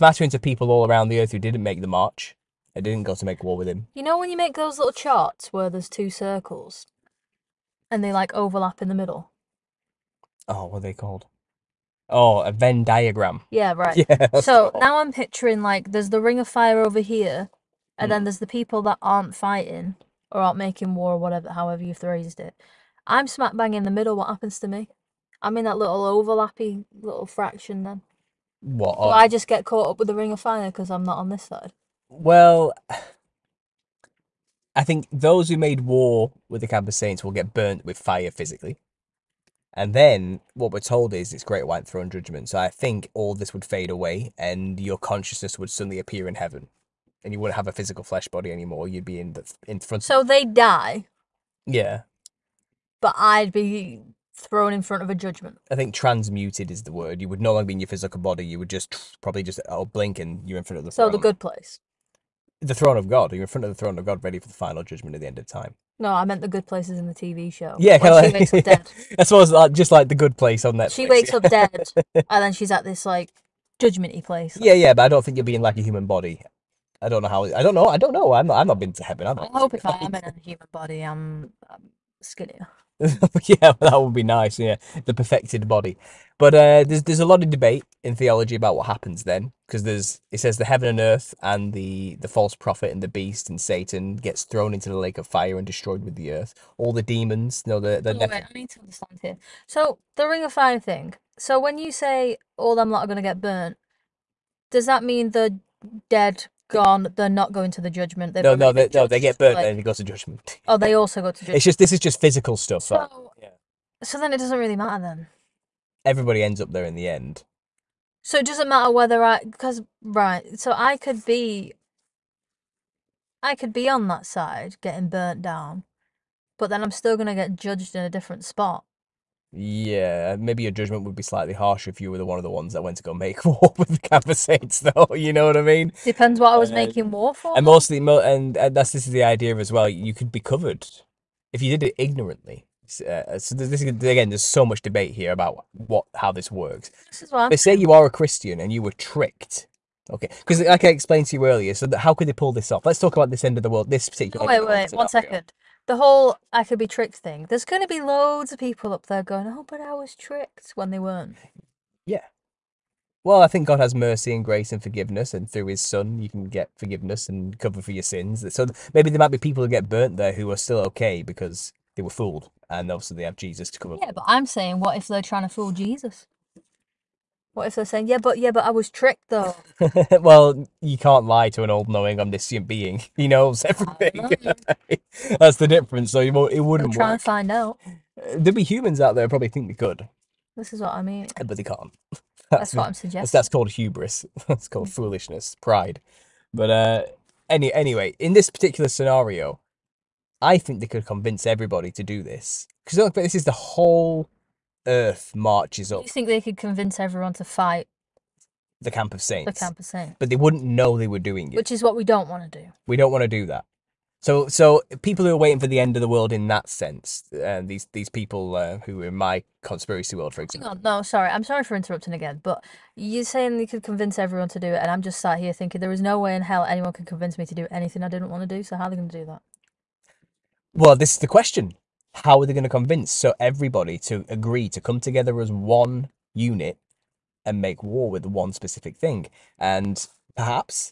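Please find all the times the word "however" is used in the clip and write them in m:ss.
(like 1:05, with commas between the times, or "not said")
0:21.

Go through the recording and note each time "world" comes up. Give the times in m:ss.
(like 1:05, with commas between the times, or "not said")
2:33, 3:36, 3:40.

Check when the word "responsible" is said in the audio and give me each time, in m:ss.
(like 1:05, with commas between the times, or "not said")
not said.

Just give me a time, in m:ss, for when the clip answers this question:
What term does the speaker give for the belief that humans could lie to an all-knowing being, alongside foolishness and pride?
3:13.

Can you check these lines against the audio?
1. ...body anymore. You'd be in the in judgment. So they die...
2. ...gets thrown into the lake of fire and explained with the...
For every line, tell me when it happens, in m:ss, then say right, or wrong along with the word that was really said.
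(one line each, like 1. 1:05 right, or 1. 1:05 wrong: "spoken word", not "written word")
1. 0:48 wrong: "front", not "judgment"
2. 1:34 wrong: "destroyed", not "explained".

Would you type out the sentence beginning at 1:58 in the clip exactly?
So it doesn't matter whether I because right.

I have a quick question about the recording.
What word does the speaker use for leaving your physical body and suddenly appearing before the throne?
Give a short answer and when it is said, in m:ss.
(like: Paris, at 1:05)
transmuted, at 0:55.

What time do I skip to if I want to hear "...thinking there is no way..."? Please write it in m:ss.
3:45.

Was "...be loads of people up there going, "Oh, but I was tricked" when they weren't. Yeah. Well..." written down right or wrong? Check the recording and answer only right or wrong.
right.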